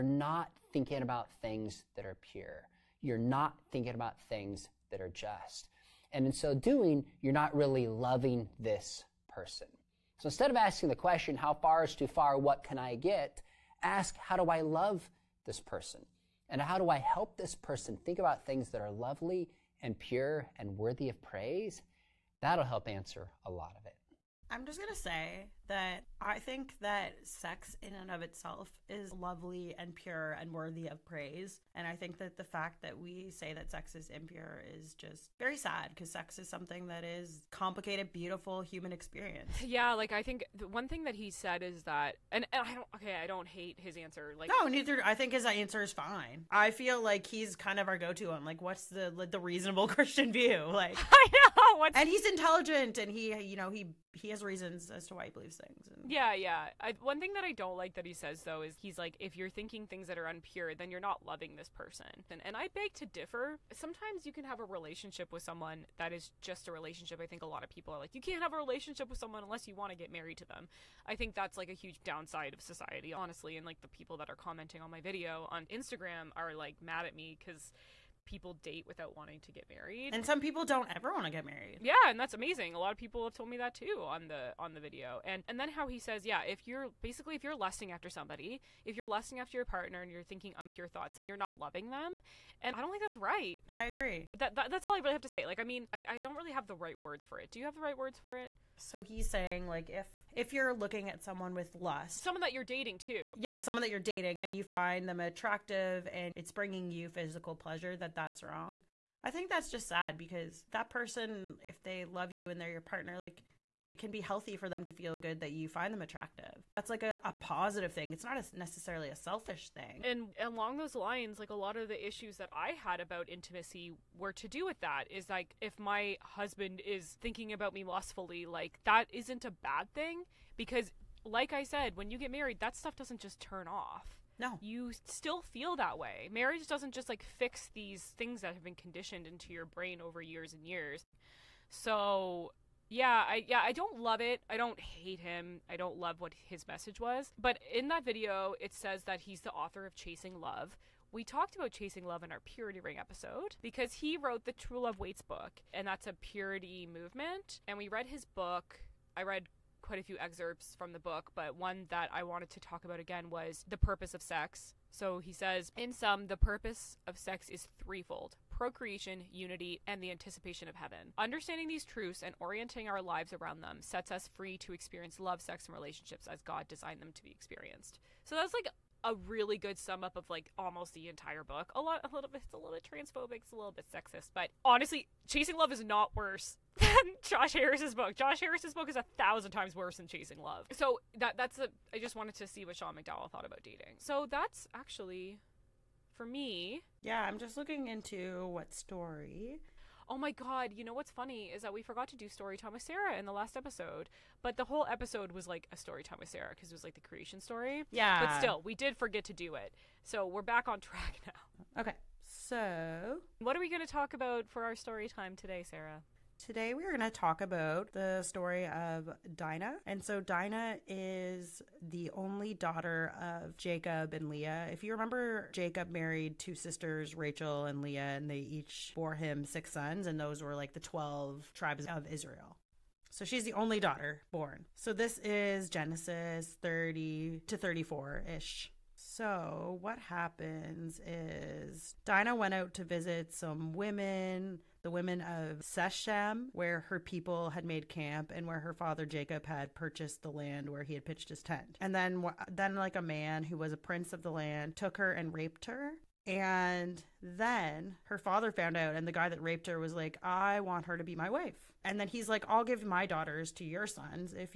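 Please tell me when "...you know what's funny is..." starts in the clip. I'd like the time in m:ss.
3:20.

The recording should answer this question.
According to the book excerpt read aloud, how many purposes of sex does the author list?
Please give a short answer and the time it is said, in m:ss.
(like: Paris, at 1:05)
3, at 2:47.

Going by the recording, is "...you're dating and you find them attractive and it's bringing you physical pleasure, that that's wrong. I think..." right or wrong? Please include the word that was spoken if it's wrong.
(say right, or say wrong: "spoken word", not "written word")
right.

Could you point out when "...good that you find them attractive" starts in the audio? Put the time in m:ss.
1:55.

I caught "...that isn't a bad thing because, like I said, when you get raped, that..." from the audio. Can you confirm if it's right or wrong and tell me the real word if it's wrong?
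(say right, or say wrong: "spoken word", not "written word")
wrong: "married", not "raped".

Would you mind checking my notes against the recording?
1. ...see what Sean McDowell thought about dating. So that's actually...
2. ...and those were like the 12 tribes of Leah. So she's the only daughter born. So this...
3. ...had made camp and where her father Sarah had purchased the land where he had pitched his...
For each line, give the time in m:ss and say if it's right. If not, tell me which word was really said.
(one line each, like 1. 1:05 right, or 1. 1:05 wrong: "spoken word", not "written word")
1. 3:12 right
2. 3:50 wrong: "Israel", not "Leah"
3. 4:07 wrong: "Jacob", not "Sarah".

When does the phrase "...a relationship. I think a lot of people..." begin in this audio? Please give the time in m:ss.
1:06.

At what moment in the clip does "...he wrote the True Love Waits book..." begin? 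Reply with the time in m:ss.
2:33.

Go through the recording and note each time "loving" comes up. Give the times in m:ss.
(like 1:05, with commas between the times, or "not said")
0:07, 1:01, 1:31.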